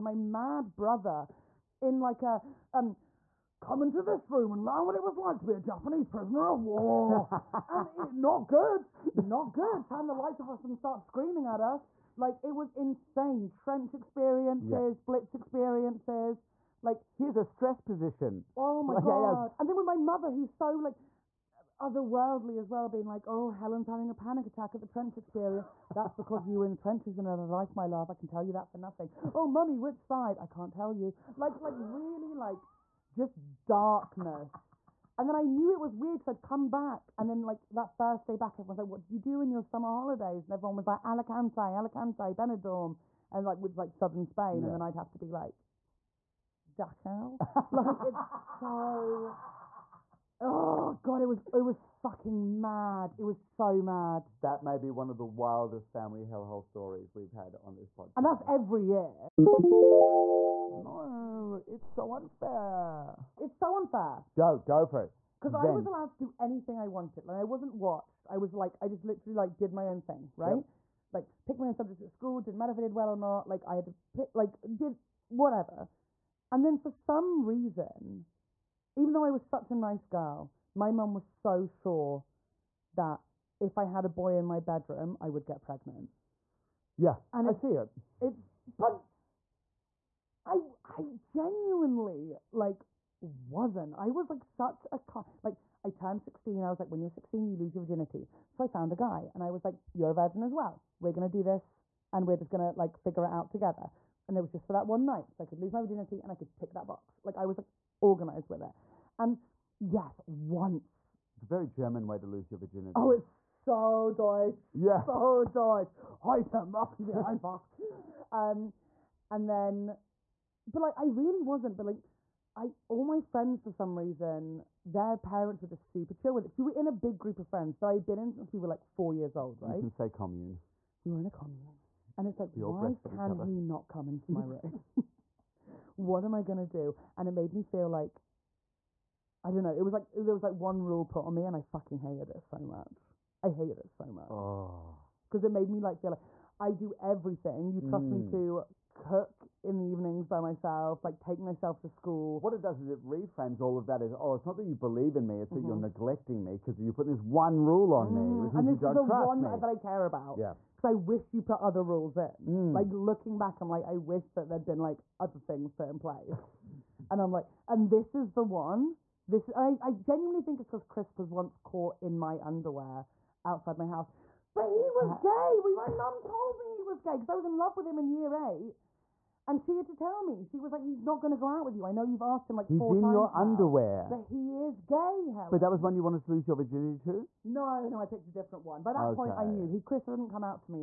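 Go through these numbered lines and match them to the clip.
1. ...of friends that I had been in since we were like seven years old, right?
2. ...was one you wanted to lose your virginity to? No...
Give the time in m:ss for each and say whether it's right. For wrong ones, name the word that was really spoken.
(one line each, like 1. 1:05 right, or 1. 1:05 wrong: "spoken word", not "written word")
1. 2:07 wrong: "four", not "seven"
2. 3:05 right.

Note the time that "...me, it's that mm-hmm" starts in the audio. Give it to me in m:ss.
2:35.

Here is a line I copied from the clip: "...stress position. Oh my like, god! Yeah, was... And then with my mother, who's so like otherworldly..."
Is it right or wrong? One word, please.
right.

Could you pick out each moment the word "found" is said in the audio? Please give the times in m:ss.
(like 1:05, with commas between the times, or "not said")
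1:38.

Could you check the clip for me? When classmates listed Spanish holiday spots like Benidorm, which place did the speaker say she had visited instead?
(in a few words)
Dachau.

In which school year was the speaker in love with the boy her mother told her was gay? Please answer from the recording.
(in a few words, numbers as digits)
Year 8.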